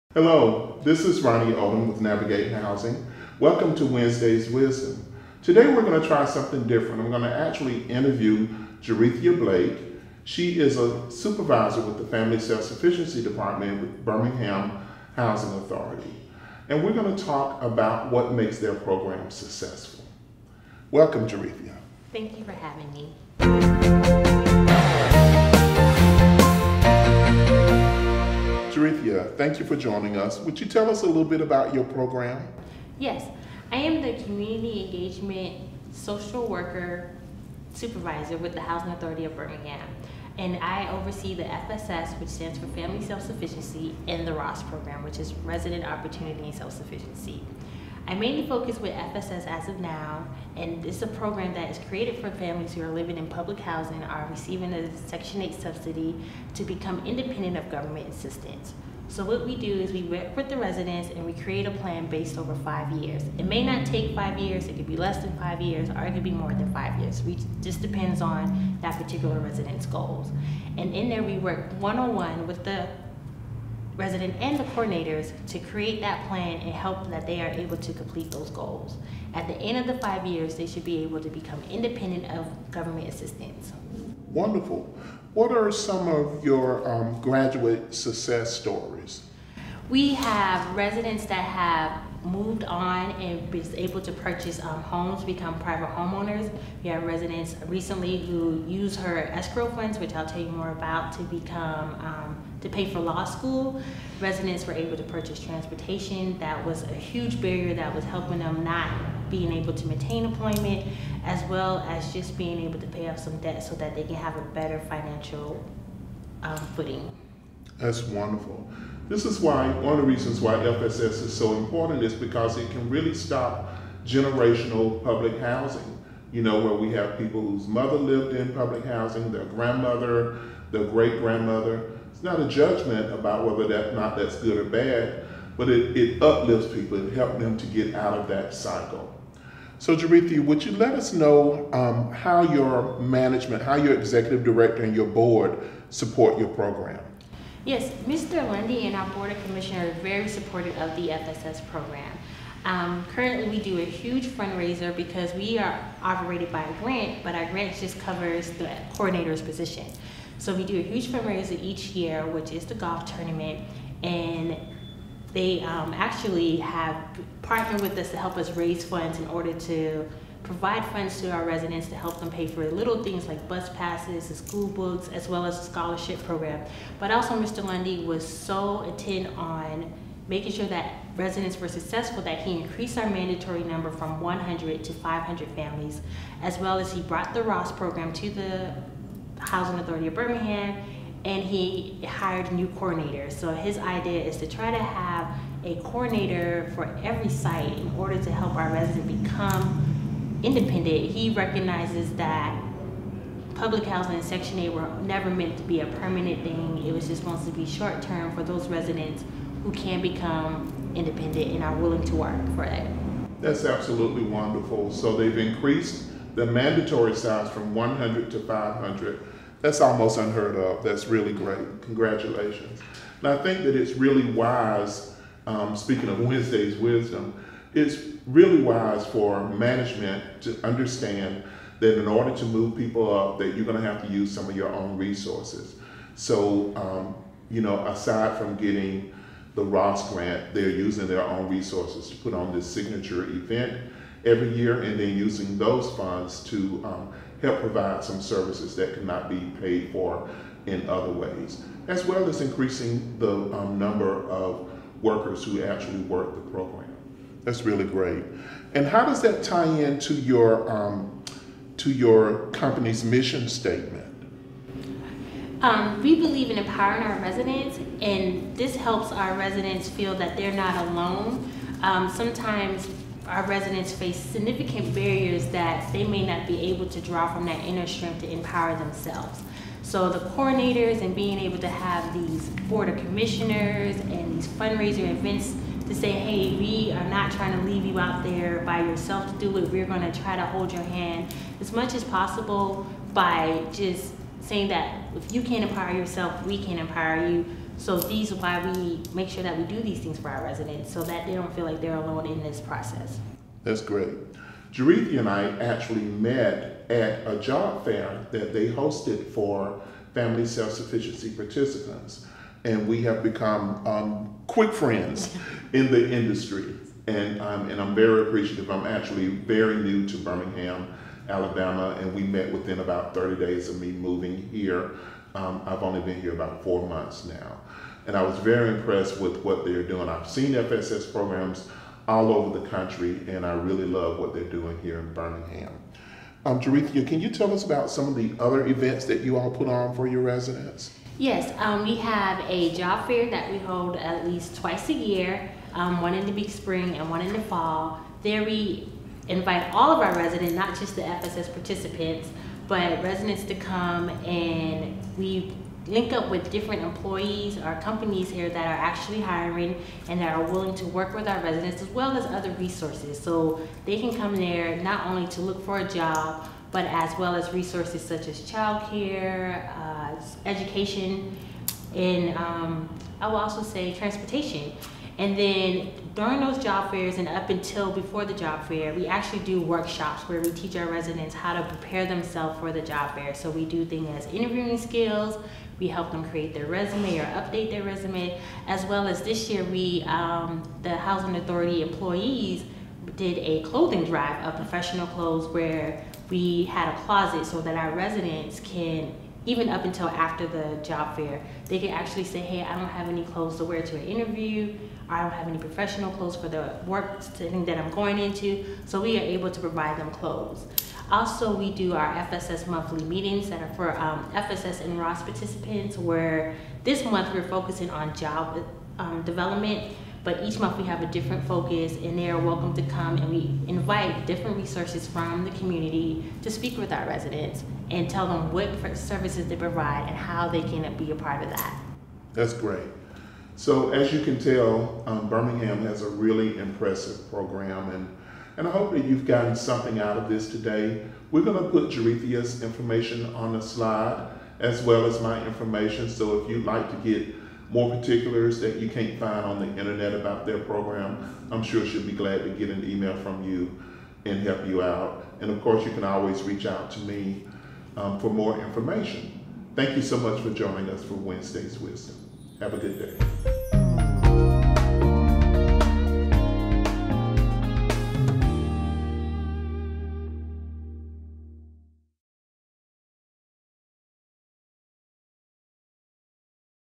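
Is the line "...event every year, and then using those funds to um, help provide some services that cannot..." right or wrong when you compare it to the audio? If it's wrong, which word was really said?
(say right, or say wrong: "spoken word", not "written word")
right.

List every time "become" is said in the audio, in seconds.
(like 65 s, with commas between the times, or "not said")
56 s, 81 s, 95 s, 101 s, 199 s, 210 s, 313 s.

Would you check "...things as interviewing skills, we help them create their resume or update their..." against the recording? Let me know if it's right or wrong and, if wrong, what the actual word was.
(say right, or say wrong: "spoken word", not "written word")
right.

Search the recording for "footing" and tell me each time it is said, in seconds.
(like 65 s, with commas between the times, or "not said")
116 s.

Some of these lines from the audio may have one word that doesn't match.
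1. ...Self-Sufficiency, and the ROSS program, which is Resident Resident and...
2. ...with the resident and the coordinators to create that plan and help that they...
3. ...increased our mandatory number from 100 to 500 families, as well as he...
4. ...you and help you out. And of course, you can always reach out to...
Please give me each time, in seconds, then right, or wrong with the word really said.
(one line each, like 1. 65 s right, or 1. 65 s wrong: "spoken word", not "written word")
1. 43 s wrong: "Opportunity", not "Resident"
2. 72 s right
3. 182 s right
4. 453 s right.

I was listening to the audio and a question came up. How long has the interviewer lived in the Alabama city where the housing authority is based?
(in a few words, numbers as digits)
4 months.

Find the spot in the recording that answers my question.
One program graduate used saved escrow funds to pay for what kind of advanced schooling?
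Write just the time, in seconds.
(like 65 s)
103 s.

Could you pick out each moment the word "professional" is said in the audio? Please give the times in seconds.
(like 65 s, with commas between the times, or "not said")
394 s, 405 s.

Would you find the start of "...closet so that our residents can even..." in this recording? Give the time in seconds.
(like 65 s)
397 s.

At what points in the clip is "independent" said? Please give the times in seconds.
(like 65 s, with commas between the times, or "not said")
57 s, 81 s, 200 s, 210 s.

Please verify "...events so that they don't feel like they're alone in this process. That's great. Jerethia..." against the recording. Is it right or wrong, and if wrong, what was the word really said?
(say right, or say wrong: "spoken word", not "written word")
wrong: "residents", not "events".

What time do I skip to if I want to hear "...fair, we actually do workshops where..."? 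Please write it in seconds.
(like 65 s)
378 s.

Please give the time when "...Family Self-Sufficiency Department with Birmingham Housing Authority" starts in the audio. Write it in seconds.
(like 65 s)
12 s.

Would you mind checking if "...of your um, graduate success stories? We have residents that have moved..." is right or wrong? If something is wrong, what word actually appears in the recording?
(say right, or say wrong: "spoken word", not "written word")
right.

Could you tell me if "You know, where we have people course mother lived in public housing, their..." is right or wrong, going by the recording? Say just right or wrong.
wrong.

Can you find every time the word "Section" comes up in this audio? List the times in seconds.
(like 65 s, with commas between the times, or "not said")
55 s, 204 s.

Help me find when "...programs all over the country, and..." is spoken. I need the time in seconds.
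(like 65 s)
331 s.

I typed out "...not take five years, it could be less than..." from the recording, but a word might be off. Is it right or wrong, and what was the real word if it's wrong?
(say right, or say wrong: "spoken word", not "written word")
right.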